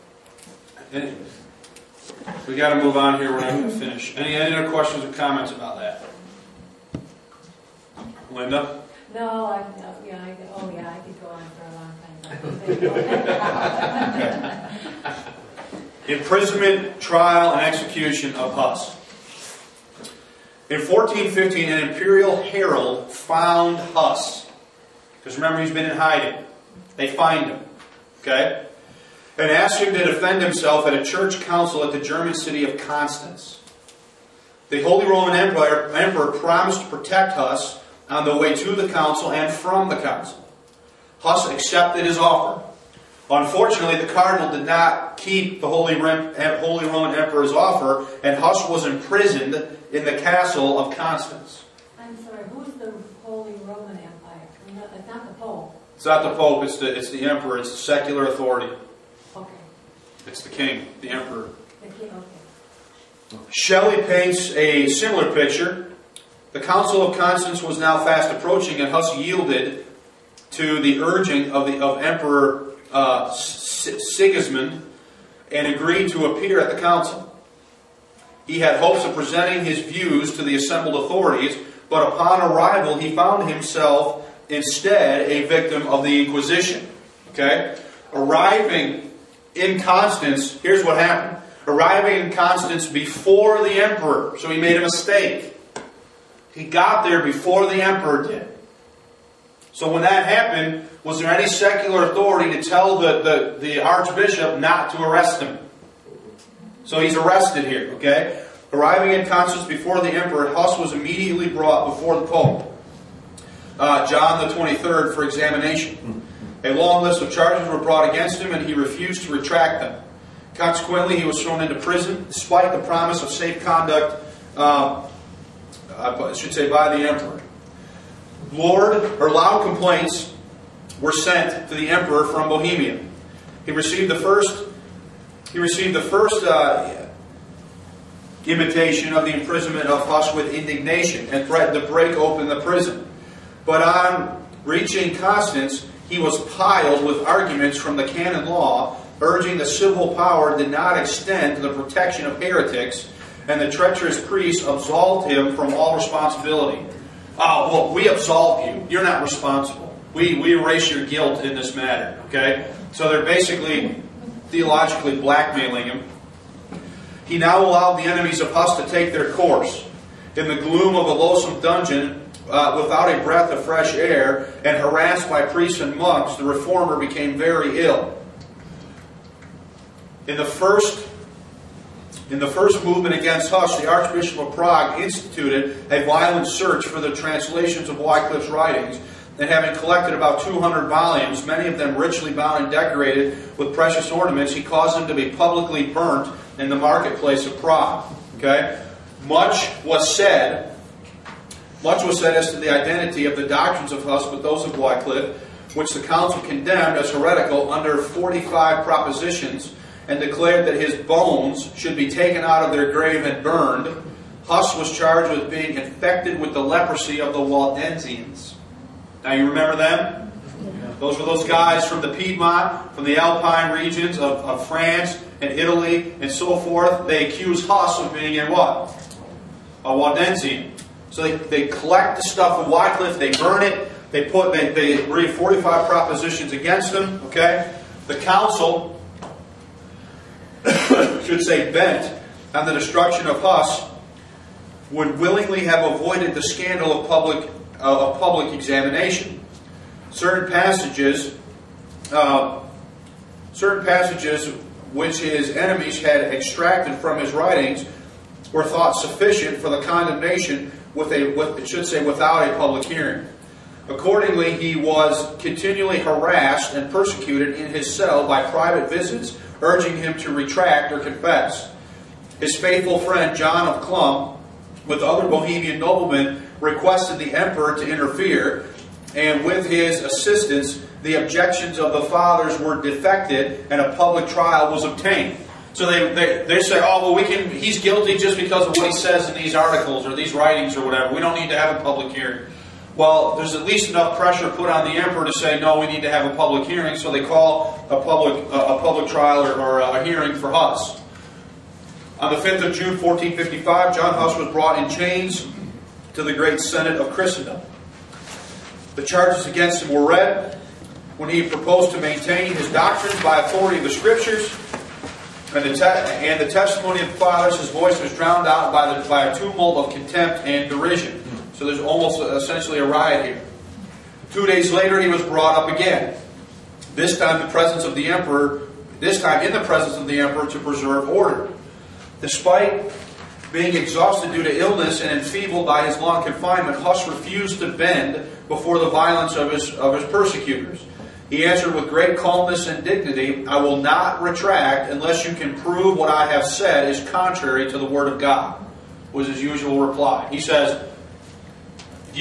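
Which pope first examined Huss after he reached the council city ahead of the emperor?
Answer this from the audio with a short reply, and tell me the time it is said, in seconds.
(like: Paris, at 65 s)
John the 23rd, at 114 s.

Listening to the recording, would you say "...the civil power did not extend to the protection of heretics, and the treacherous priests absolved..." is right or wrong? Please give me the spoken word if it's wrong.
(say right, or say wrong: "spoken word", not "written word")
right.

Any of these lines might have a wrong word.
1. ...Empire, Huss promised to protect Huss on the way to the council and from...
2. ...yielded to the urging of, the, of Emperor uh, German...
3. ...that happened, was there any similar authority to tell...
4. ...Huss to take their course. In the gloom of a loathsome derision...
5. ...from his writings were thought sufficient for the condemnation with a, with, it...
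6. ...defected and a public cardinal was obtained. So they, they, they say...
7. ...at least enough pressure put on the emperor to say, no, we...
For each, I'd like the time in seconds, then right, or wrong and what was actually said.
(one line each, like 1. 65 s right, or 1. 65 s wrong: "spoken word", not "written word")
1. 35 s wrong: "Emperor", not "Huss"
2. 69 s wrong: "Sigismund", not "German"
3. 100 s wrong: "secular", not "similar"
4. 168 s wrong: "dungeon", not "derision"
5. 256 s right
6. 282 s wrong: "trial", not "cardinal"
7. 293 s right.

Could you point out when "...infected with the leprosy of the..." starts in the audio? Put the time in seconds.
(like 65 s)
215 s.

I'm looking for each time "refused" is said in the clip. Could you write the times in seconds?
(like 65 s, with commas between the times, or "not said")
118 s, 337 s.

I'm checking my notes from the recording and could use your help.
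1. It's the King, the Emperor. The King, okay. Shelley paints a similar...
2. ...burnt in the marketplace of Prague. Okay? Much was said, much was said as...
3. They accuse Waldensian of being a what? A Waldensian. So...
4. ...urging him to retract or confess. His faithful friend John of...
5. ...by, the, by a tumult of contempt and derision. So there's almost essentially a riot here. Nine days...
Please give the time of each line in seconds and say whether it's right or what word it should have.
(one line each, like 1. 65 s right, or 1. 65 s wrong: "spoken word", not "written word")
1. 60 s right
2. 195 s right
3. 227 s wrong: "Huss", not "Waldensian"
4. 269 s right
5. 318 s wrong: "Two", not "Nine".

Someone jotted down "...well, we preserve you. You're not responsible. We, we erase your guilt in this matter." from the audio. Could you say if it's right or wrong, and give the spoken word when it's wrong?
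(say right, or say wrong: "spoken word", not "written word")
wrong: "absolve", not "preserve".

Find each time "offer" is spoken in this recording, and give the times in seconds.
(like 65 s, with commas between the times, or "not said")
42 s, 47 s.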